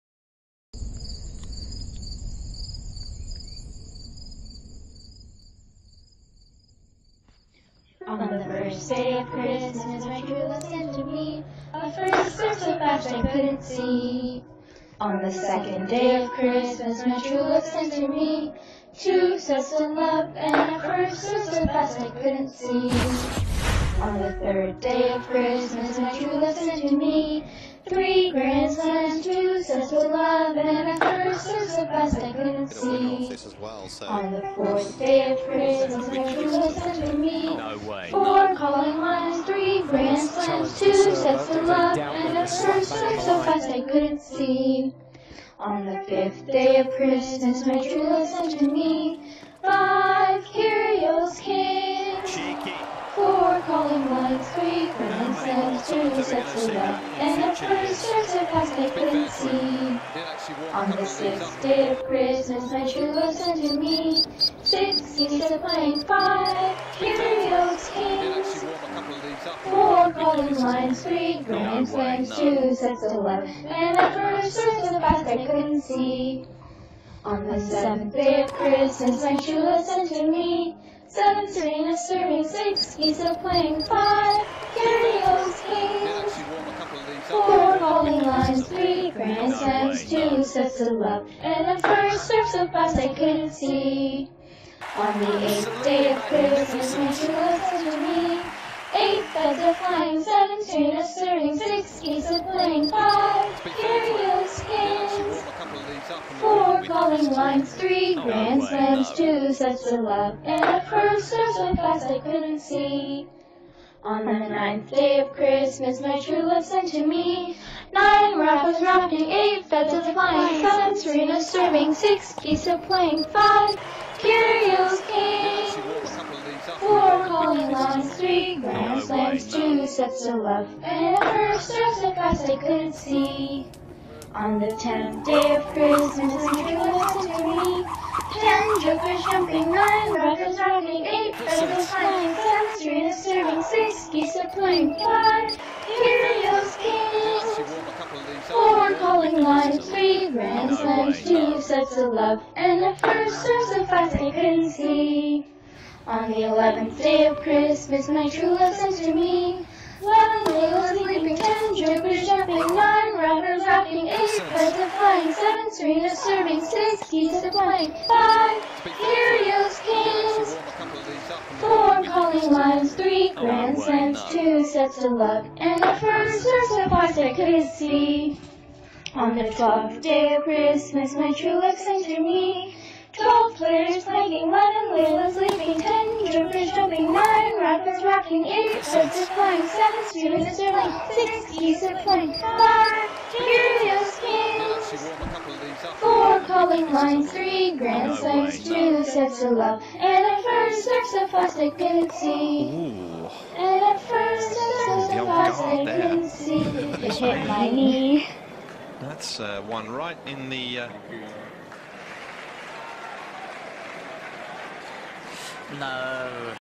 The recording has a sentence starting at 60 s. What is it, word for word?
On the sixth day of Christmas, my true love sent to me six geese of playing five curious kings.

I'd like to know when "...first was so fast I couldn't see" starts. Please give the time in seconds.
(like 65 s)
74 s.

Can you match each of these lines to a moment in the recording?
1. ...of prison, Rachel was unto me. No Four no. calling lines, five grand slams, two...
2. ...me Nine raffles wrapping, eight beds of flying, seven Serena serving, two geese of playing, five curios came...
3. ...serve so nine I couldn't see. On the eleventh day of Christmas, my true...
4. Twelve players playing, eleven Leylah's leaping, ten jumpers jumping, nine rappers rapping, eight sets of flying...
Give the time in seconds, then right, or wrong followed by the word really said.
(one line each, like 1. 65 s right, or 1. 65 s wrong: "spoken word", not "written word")
1. 35 s wrong: "three", not "five"
2. 117 s wrong: "six", not "two"
3. 153 s wrong: "five", not "nine"
4. 183 s right.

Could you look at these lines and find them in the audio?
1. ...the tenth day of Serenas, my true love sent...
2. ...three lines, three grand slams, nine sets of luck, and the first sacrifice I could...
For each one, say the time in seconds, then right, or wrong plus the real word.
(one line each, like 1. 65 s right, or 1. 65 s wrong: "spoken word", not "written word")
1. 134 s wrong: "Christmas", not "Serenas"
2. 172 s wrong: "two", not "nine".